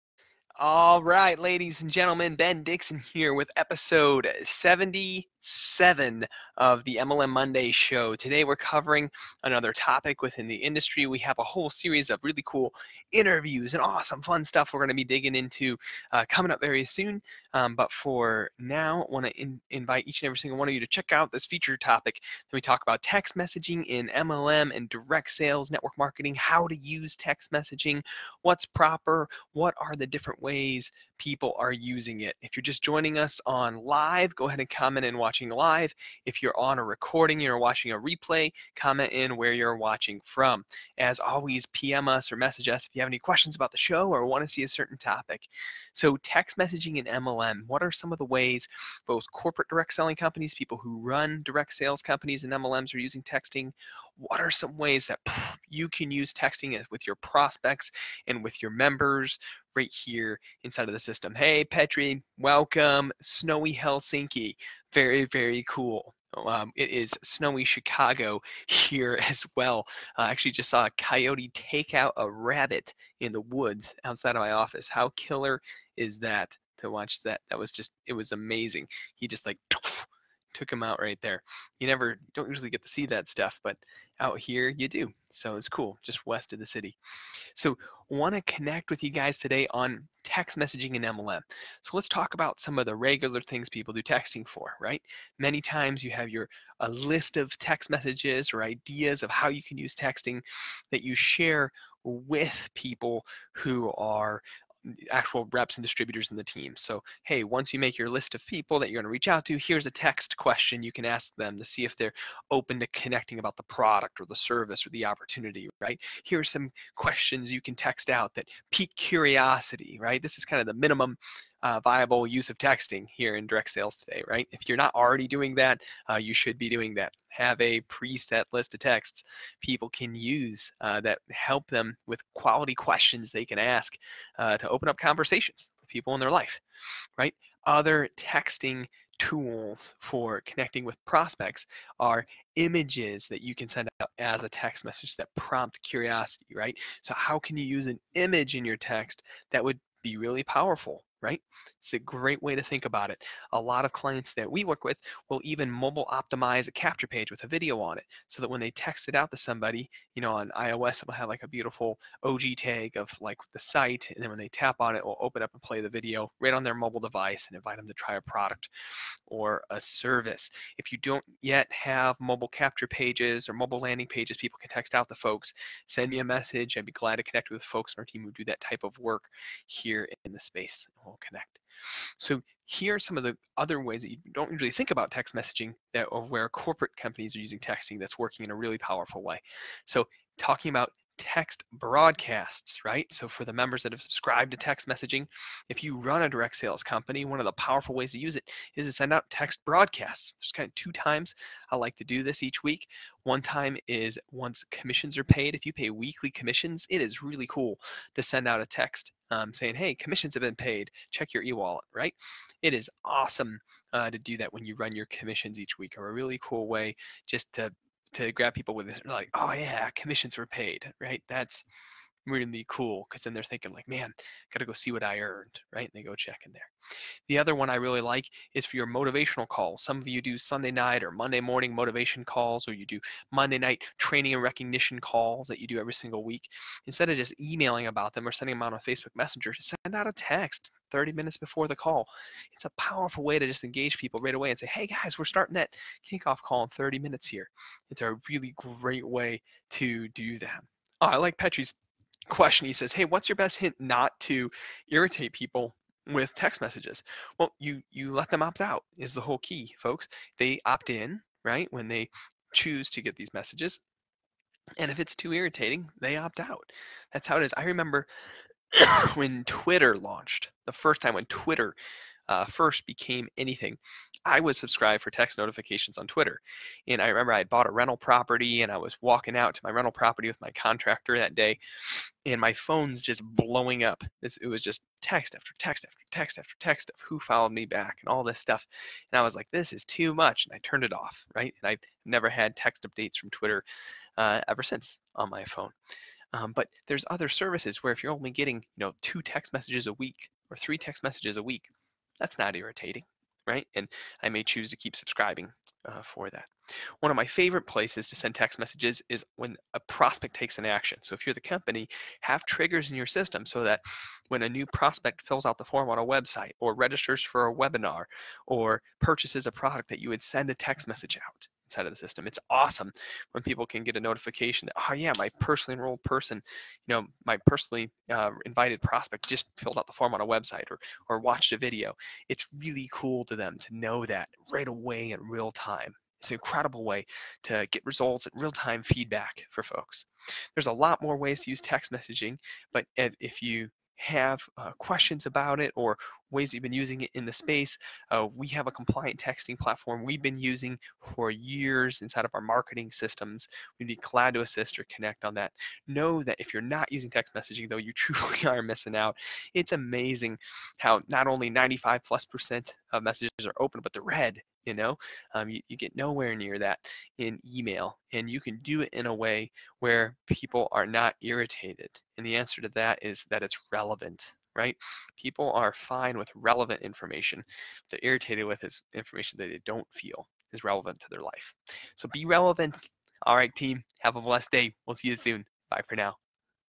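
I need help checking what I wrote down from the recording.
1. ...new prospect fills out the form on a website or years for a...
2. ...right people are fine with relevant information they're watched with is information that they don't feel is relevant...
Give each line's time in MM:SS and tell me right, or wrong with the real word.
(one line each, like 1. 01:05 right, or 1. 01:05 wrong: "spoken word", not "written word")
1. 05:14 wrong: "registers", not "years"
2. 06:14 wrong: "irritated", not "watched".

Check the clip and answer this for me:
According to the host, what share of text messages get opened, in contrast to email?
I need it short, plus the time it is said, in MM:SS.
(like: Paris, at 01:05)
95 plus percent, at 06:01.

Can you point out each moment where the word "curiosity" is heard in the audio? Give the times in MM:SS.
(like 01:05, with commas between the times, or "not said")
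01:58, 02:25.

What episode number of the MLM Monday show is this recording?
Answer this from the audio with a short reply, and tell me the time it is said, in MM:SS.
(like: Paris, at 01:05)
77, at 00:04.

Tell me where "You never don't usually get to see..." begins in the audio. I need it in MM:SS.
01:21.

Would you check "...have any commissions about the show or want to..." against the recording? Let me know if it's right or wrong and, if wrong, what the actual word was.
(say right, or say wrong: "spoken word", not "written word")
wrong: "questions", not "commissions".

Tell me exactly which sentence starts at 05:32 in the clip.
It's really cool to them to know that right away in real time.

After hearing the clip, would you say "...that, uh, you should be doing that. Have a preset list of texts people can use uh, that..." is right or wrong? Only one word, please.
right.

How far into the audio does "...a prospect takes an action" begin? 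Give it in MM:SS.
05:09.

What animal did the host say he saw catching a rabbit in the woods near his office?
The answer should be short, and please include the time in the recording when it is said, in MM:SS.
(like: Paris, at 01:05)
Coyote, at 01:10.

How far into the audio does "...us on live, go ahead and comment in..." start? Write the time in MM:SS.
00:33.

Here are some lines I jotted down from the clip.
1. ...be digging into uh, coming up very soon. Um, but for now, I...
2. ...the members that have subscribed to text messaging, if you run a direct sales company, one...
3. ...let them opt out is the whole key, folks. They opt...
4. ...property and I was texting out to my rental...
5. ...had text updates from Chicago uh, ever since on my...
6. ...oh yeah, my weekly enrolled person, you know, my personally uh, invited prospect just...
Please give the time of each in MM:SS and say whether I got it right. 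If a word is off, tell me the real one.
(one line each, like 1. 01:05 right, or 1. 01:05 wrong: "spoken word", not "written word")
1. 00:14 right
2. 03:13 right
3. 04:18 right
4. 04:37 wrong: "walking", not "texting"
5. 04:52 wrong: "Twitter", not "Chicago"
6. 05:24 wrong: "personally", not "weekly".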